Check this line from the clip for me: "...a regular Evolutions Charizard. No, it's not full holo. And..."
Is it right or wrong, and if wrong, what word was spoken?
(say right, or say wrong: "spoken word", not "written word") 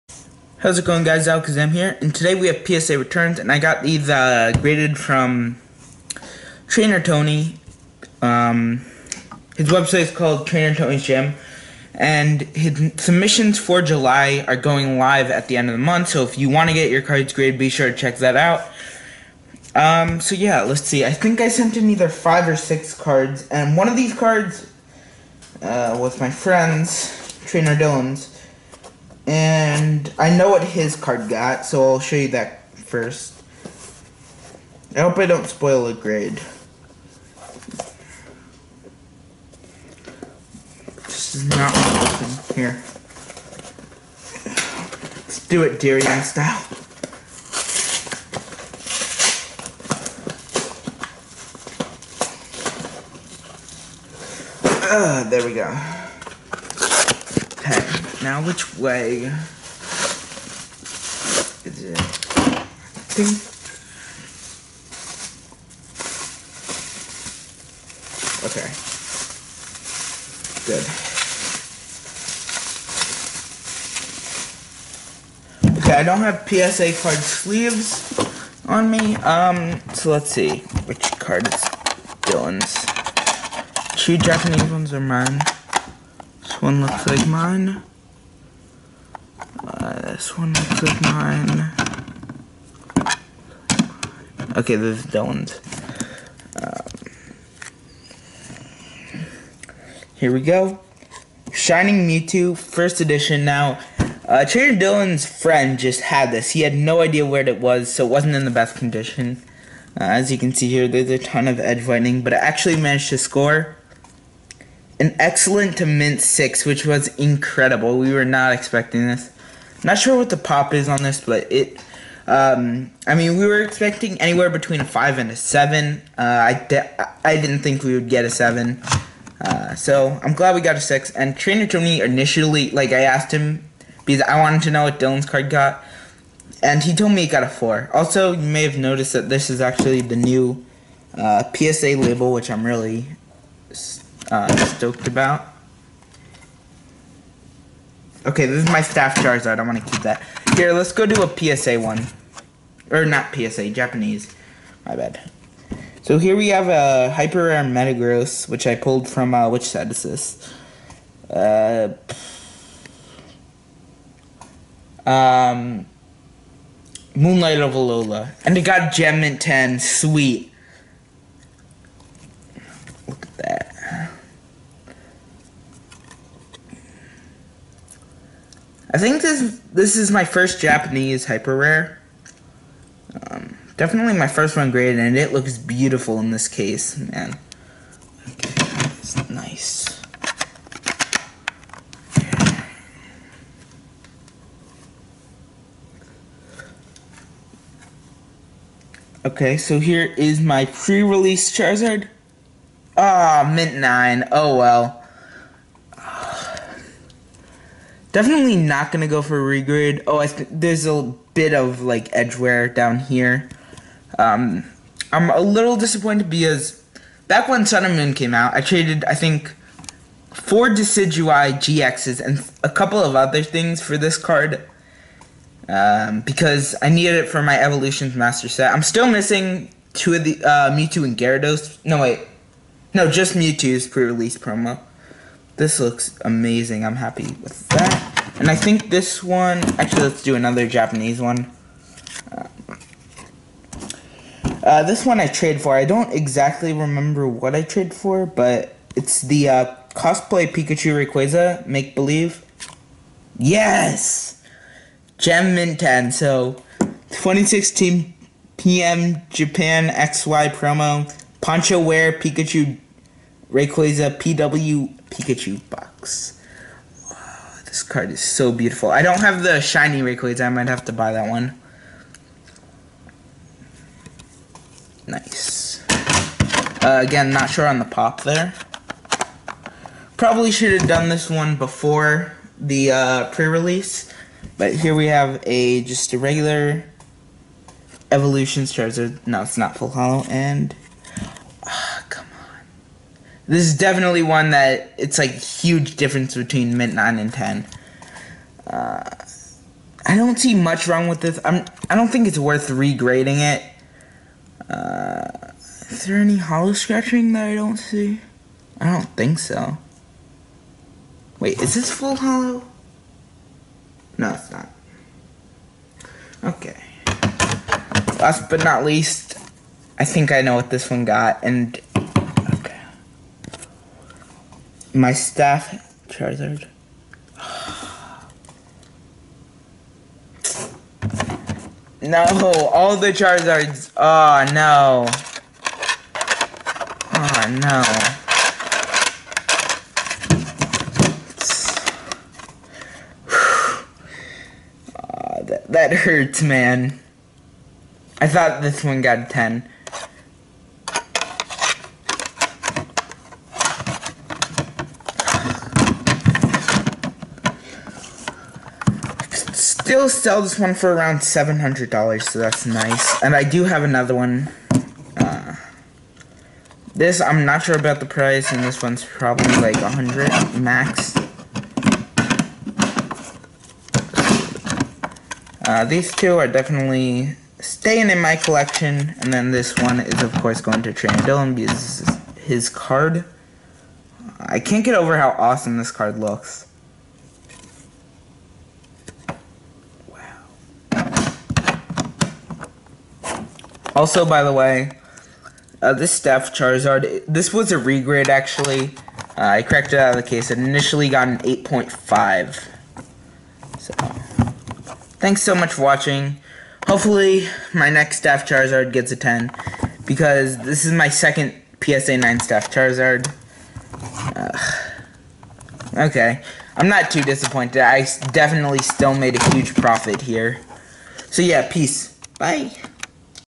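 right.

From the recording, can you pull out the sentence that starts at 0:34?
I hope I don't spoil a grade.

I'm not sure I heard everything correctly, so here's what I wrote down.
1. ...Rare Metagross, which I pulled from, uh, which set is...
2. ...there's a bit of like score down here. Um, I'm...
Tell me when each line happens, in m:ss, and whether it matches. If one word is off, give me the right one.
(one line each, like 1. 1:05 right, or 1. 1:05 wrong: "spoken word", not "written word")
1. 2:37 right
2. 3:30 wrong: "edgeware", not "score".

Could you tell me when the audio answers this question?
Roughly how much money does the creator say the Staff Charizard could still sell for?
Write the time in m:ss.
6:01.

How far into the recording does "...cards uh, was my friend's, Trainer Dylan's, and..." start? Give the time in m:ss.
0:24.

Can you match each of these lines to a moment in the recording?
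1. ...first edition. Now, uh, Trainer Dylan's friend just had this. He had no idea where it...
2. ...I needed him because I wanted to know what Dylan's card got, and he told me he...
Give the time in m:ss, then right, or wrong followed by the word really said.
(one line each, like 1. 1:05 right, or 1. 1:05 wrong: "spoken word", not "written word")
1. 1:42 right
2. 2:12 wrong: "asked", not "needed".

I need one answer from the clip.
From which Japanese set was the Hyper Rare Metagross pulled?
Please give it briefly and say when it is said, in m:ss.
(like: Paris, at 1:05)
Moonlight of Alola, at 2:47.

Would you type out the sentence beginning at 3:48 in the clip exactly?
I'm still missing two of the uh, Mewtwo and Gyarados.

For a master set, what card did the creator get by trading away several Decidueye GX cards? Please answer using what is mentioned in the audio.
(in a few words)
pre-release Charizard.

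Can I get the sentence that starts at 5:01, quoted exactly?
I'm I don't think it's worth regrading it.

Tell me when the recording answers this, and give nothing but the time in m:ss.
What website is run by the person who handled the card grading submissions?
0:10.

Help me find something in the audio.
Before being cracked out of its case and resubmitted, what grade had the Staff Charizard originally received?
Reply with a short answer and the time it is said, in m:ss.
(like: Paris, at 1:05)
8.5, at 6:41.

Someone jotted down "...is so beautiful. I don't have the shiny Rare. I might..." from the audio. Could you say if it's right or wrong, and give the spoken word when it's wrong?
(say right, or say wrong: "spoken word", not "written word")
wrong: "Rayquaza", not "Rare".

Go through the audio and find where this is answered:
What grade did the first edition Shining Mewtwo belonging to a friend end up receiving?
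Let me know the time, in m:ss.
1:55.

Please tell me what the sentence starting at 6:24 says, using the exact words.
I can't get over how awesome this card looks.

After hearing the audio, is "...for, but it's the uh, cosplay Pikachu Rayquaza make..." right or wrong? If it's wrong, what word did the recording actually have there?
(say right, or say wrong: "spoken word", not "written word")
right.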